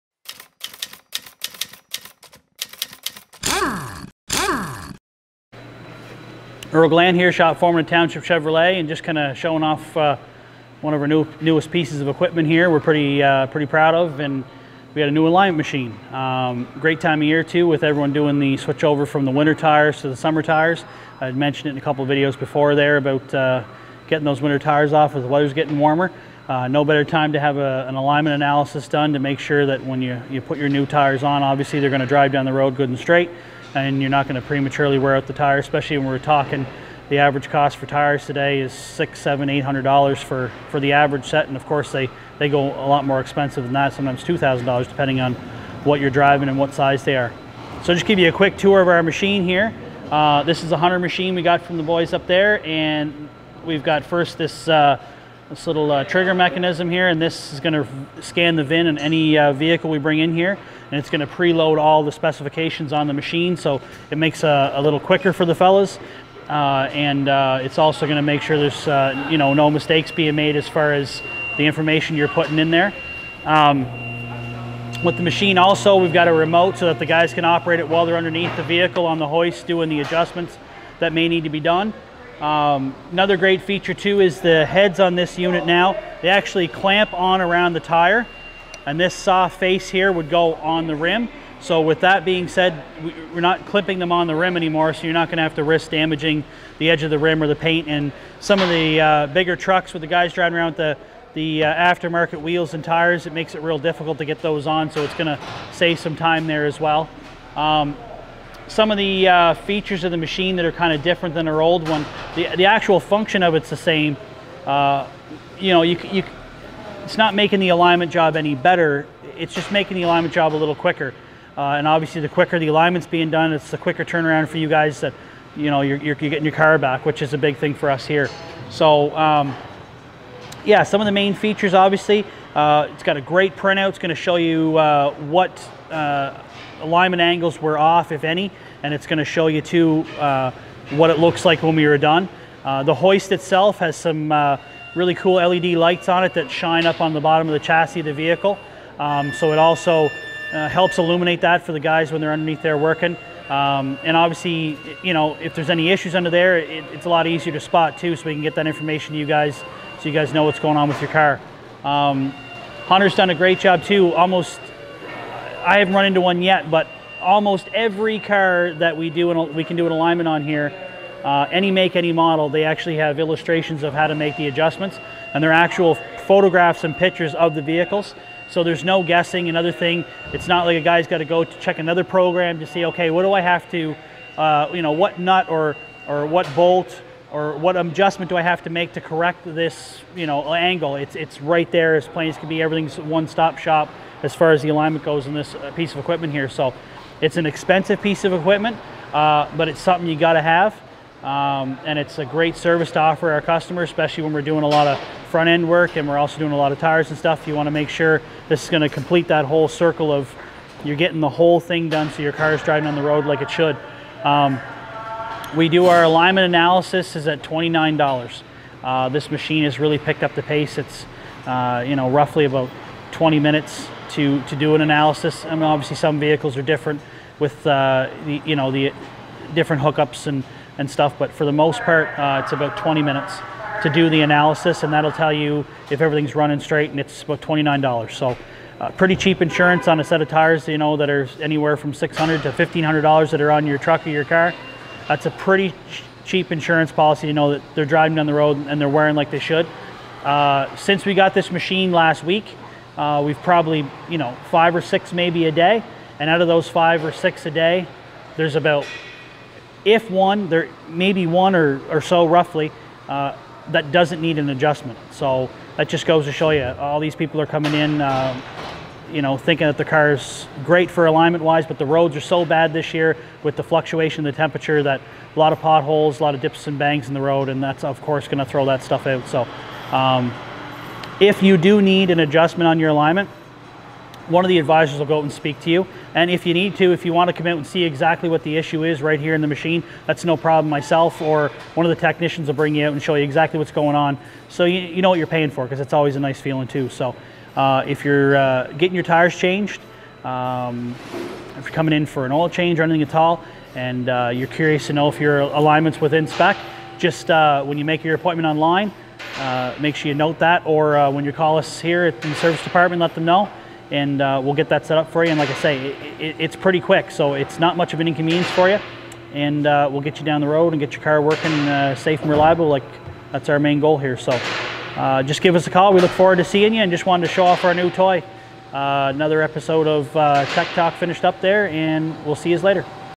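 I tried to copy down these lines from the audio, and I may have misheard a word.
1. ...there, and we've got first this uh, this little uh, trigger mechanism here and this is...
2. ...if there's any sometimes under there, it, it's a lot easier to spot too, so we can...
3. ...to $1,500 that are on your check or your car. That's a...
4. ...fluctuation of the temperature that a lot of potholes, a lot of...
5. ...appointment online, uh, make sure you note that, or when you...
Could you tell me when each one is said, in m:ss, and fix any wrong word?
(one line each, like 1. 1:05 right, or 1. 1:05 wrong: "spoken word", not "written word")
1. 0:52 right
2. 2:35 wrong: "issues", not "sometimes"
3. 4:02 wrong: "truck", not "check"
4. 4:33 right
5. 5:08 right.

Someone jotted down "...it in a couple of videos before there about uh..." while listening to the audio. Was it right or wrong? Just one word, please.
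right.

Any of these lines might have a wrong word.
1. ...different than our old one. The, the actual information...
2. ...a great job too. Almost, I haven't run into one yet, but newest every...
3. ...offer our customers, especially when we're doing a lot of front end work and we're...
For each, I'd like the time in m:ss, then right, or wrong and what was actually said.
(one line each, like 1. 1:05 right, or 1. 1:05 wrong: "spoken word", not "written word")
1. 1:51 wrong: "function", not "information"
2. 2:43 wrong: "almost", not "newest"
3. 3:22 right.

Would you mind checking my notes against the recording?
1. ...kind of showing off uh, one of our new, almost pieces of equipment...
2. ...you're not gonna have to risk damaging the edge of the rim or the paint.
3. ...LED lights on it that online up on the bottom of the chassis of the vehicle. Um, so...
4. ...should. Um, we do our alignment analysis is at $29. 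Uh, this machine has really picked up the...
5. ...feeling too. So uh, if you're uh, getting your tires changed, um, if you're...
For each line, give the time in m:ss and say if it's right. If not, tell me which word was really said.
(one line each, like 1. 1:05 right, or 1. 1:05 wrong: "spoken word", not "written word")
1. 0:09 wrong: "newest", not "almost"
2. 1:35 right
3. 2:25 wrong: "shine", not "online"
4. 3:33 right
5. 4:56 right.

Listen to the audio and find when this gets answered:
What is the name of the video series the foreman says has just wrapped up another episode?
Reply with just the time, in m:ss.
5:30.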